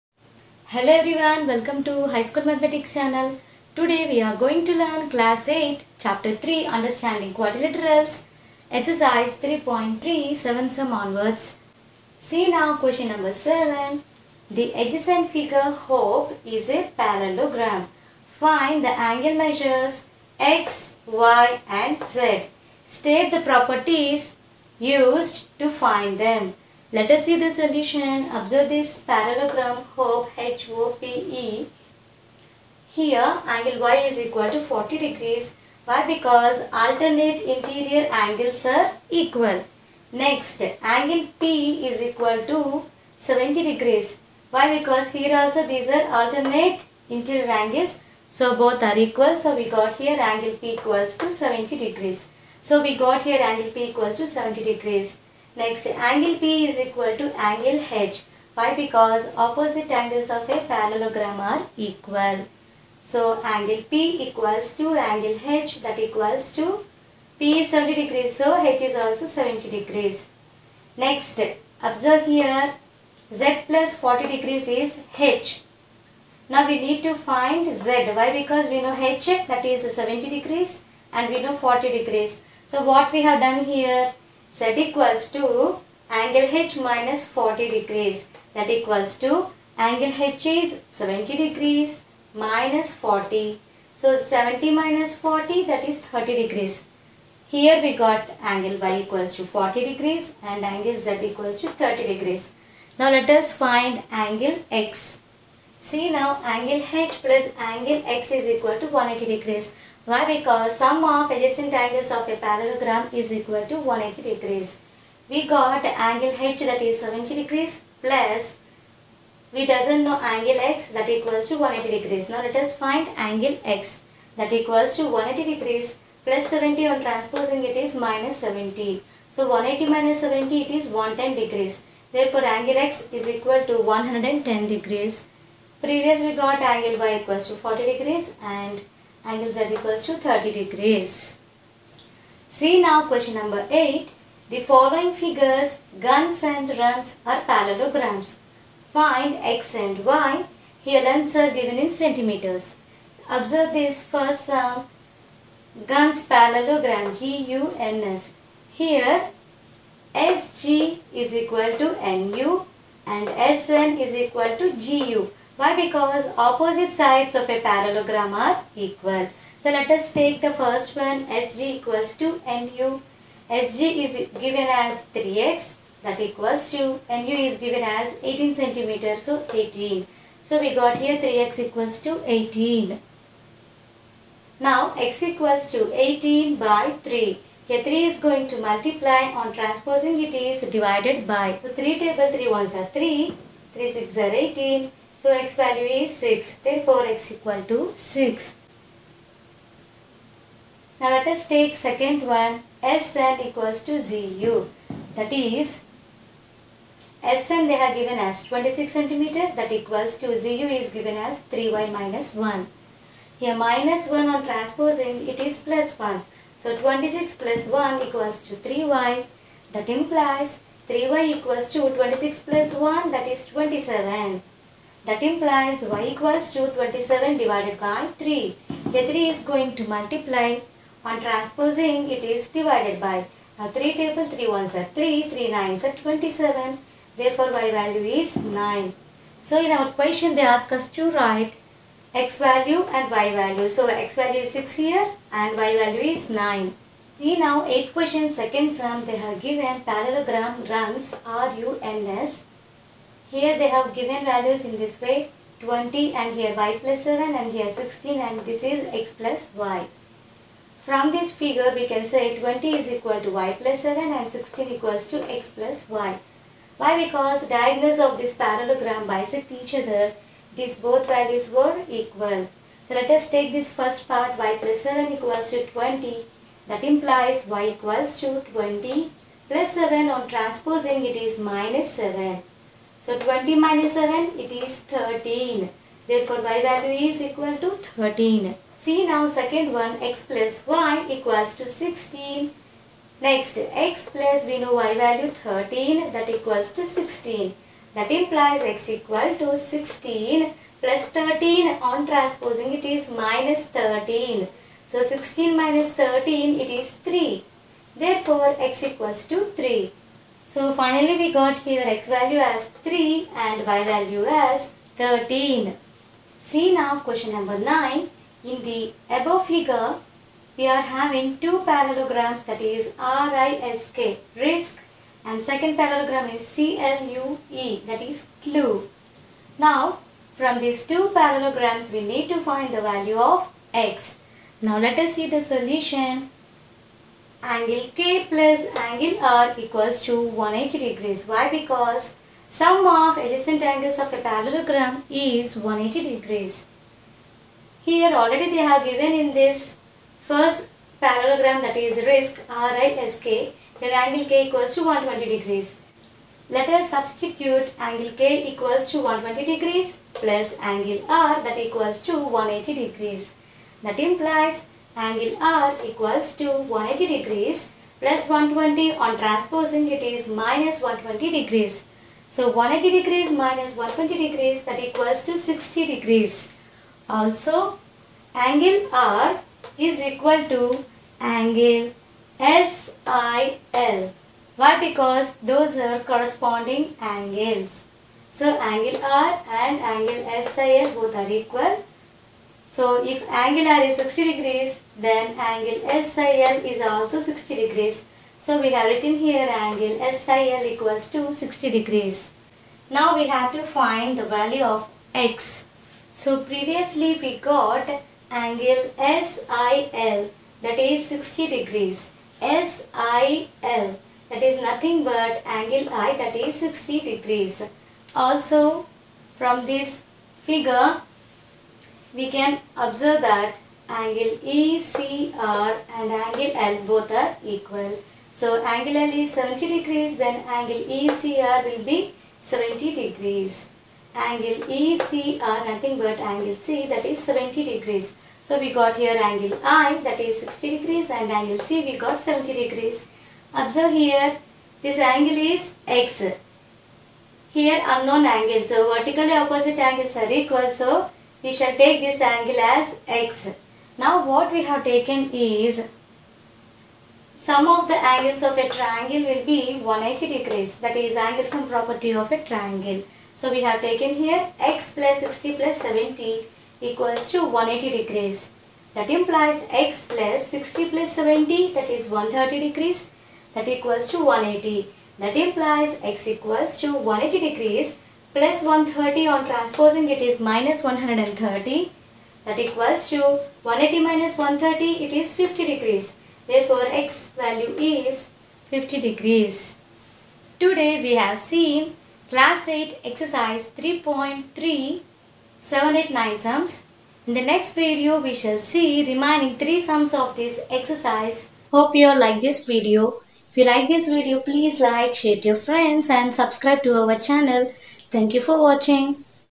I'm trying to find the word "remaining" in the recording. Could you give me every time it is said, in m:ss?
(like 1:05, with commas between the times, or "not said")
8:19.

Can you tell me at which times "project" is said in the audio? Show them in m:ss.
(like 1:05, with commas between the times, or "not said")
not said.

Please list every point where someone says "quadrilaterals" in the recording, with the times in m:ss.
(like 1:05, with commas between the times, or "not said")
0:07.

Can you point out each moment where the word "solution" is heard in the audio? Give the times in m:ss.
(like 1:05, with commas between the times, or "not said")
0:27, 5:35.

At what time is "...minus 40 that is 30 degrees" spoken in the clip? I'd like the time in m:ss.
1:34.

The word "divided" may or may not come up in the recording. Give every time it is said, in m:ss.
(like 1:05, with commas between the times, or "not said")
3:10, 3:47, 3:52.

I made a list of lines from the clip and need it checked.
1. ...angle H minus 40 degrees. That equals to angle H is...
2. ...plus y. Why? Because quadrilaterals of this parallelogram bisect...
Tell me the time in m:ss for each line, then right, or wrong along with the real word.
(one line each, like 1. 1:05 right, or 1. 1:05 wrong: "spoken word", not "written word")
1. 1:26 right
2. 4:25 wrong: "diagonals", not "quadrilaterals".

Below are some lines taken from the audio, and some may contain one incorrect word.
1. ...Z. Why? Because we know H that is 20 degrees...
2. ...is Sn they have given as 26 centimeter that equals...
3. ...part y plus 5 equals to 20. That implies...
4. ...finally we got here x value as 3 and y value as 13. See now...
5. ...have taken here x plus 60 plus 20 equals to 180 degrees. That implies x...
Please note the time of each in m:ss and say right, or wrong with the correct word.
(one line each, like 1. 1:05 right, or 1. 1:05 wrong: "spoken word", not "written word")
1. 1:17 wrong: "70", not "20"
2. 3:25 right
3. 4:34 wrong: "7", not "5"
4. 5:10 right
5. 7:43 wrong: "70", not "20".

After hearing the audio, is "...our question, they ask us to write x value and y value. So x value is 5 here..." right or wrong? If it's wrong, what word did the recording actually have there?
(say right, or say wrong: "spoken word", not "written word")
wrong: "6", not "5".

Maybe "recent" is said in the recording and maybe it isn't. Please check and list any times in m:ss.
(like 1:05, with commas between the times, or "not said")
not said.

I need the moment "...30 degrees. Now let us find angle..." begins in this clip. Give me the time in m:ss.
1:41.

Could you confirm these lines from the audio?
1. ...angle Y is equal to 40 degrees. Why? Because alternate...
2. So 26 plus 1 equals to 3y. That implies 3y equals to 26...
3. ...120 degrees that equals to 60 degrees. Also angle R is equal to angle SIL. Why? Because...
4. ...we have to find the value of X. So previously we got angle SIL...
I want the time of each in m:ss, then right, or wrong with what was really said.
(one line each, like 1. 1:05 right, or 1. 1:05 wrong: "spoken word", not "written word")
1. 0:33 right
2. 3:36 right
3. 6:13 right
4. 6:43 right.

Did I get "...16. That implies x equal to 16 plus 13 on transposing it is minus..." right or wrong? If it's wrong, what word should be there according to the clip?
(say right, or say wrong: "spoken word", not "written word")
right.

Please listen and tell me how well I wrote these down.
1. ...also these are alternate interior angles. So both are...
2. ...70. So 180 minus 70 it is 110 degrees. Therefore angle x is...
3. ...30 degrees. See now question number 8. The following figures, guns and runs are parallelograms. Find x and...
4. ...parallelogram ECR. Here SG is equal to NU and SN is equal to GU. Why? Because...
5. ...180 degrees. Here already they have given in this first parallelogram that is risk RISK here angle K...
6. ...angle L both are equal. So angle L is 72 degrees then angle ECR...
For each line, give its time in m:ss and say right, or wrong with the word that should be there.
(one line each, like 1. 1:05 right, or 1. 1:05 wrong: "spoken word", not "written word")
1. 0:45 right
2. 2:08 right
3. 2:20 right
4. 2:36 wrong: "GUNS", not "ECR"
5. 5:45 right
6. 7:06 wrong: "70", not "72".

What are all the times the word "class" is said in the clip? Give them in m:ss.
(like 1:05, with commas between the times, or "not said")
0:05, 8:12.